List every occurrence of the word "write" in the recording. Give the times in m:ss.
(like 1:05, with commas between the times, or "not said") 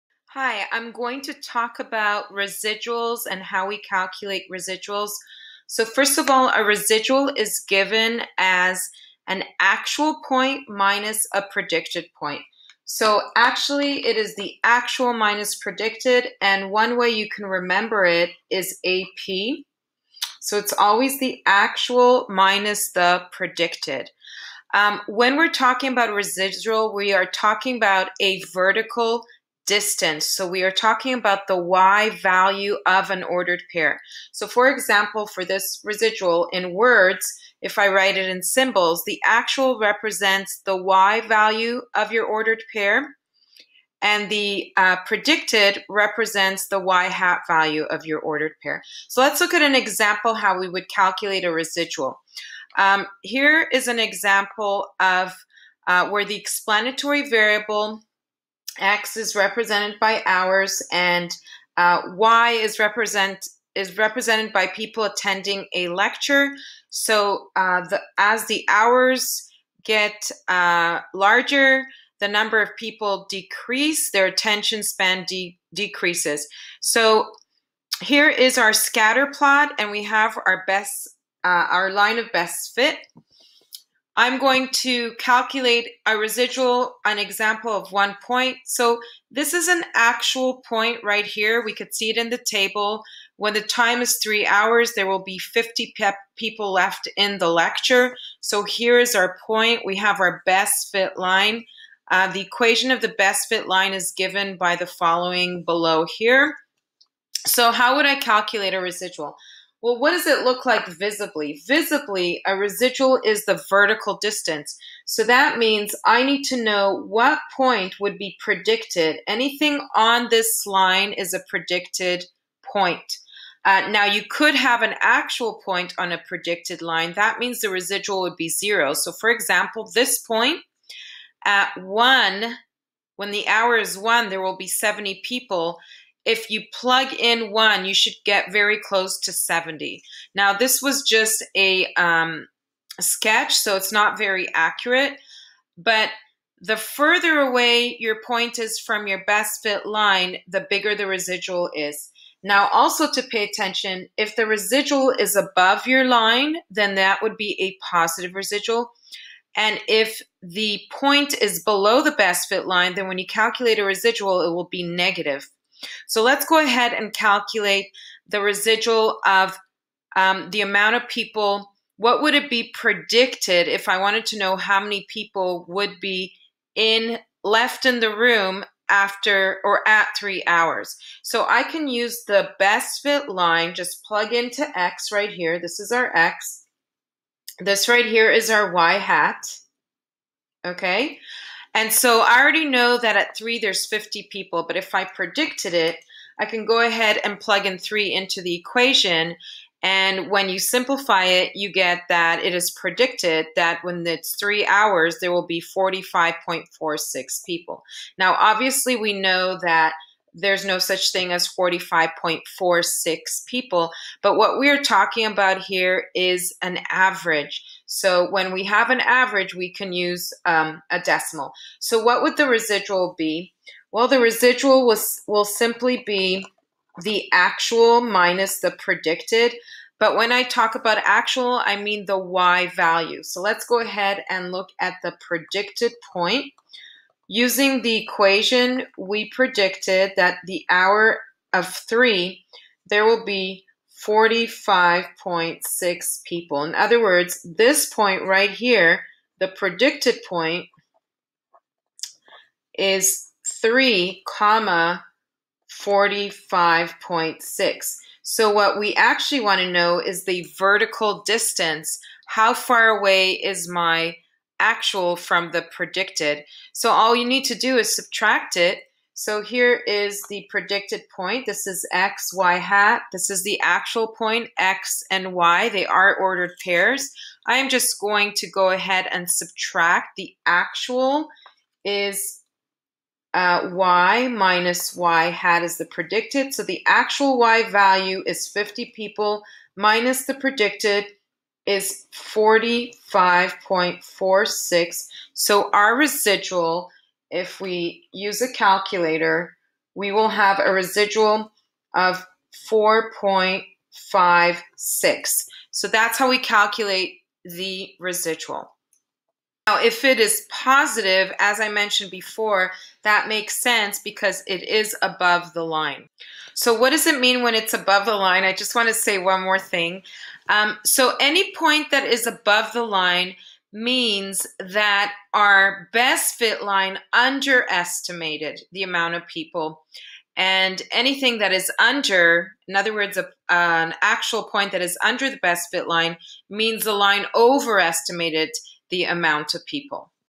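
0:37.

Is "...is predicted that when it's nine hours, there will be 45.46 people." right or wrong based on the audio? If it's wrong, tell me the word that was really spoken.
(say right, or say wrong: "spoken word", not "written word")
wrong: "three", not "nine".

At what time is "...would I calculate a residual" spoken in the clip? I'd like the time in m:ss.
1:47.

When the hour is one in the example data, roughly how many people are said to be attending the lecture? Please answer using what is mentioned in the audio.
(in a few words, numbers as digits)
70.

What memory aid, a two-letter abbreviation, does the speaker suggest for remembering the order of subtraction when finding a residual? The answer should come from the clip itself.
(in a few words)
AP.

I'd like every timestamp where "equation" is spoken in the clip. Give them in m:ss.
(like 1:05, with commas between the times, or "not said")
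1:42, 3:18, 3:58.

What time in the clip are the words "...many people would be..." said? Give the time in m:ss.
2:54.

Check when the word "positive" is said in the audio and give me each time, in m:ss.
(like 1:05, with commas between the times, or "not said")
2:37, 5:10.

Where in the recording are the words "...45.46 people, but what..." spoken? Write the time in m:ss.
3:31.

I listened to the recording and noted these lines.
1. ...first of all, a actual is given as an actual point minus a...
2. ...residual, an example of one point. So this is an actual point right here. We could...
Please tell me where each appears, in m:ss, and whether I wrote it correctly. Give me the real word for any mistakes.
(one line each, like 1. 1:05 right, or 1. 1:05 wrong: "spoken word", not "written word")
1. 0:05 wrong: "residual", not "actual"
2. 1:26 right.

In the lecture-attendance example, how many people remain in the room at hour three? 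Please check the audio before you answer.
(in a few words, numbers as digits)
50.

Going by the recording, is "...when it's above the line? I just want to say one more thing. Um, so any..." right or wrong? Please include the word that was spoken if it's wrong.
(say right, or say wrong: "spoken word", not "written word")
right.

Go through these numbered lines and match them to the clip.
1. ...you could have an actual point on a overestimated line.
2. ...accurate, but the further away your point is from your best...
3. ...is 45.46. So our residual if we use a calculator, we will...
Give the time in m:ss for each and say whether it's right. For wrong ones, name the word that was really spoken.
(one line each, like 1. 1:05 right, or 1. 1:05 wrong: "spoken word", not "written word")
1. 2:04 wrong: "predicted", not "overestimated"
2. 2:24 right
3. 4:51 right.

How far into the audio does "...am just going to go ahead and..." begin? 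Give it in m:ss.
4:37.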